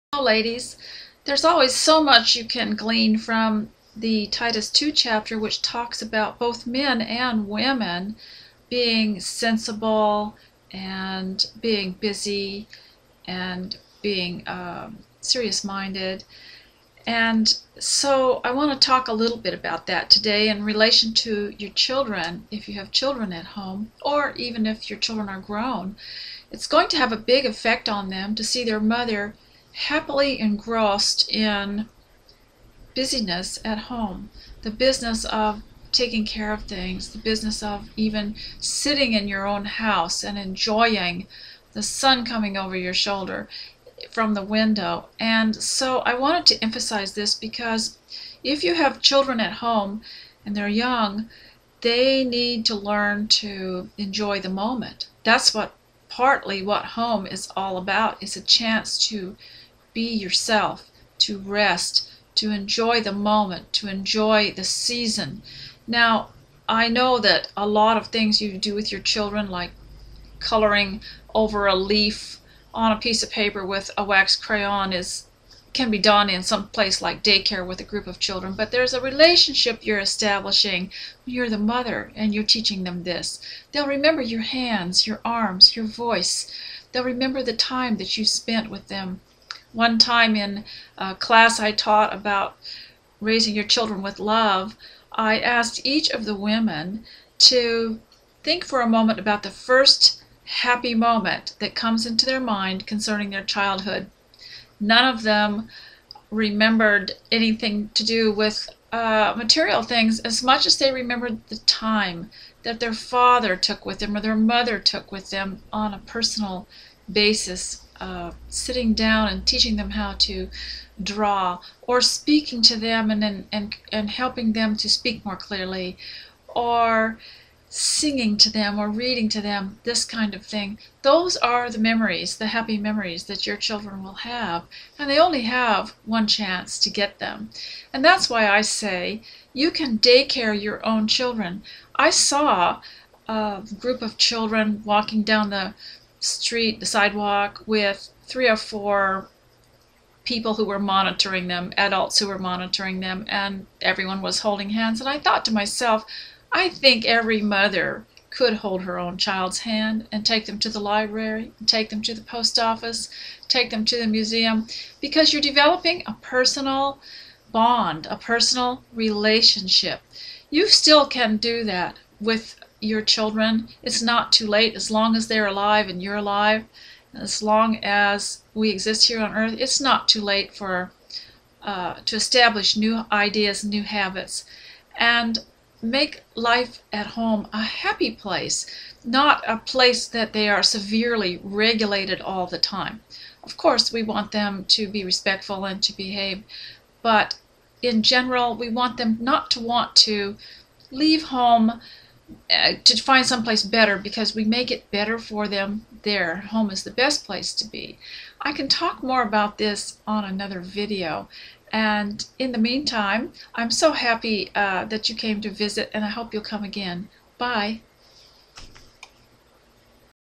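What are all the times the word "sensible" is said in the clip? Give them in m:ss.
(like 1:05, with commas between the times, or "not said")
0:09.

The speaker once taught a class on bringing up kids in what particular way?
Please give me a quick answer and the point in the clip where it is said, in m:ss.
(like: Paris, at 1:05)
with love, at 1:34.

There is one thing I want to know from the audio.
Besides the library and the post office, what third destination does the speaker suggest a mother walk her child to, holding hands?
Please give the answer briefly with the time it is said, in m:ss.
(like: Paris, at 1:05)
the museum, at 2:43.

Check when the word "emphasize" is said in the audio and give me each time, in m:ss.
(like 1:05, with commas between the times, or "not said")
0:46.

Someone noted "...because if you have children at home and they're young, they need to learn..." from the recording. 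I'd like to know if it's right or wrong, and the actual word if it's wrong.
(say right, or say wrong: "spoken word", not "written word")
right.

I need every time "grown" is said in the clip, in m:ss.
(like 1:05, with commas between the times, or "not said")
0:25.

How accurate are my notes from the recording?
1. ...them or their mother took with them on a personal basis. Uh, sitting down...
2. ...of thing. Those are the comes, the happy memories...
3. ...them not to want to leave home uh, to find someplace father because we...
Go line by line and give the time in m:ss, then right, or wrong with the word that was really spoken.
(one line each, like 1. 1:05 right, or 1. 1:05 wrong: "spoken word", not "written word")
1. 1:53 right
2. 2:10 wrong: "memories", not "comes"
3. 3:18 wrong: "better", not "father".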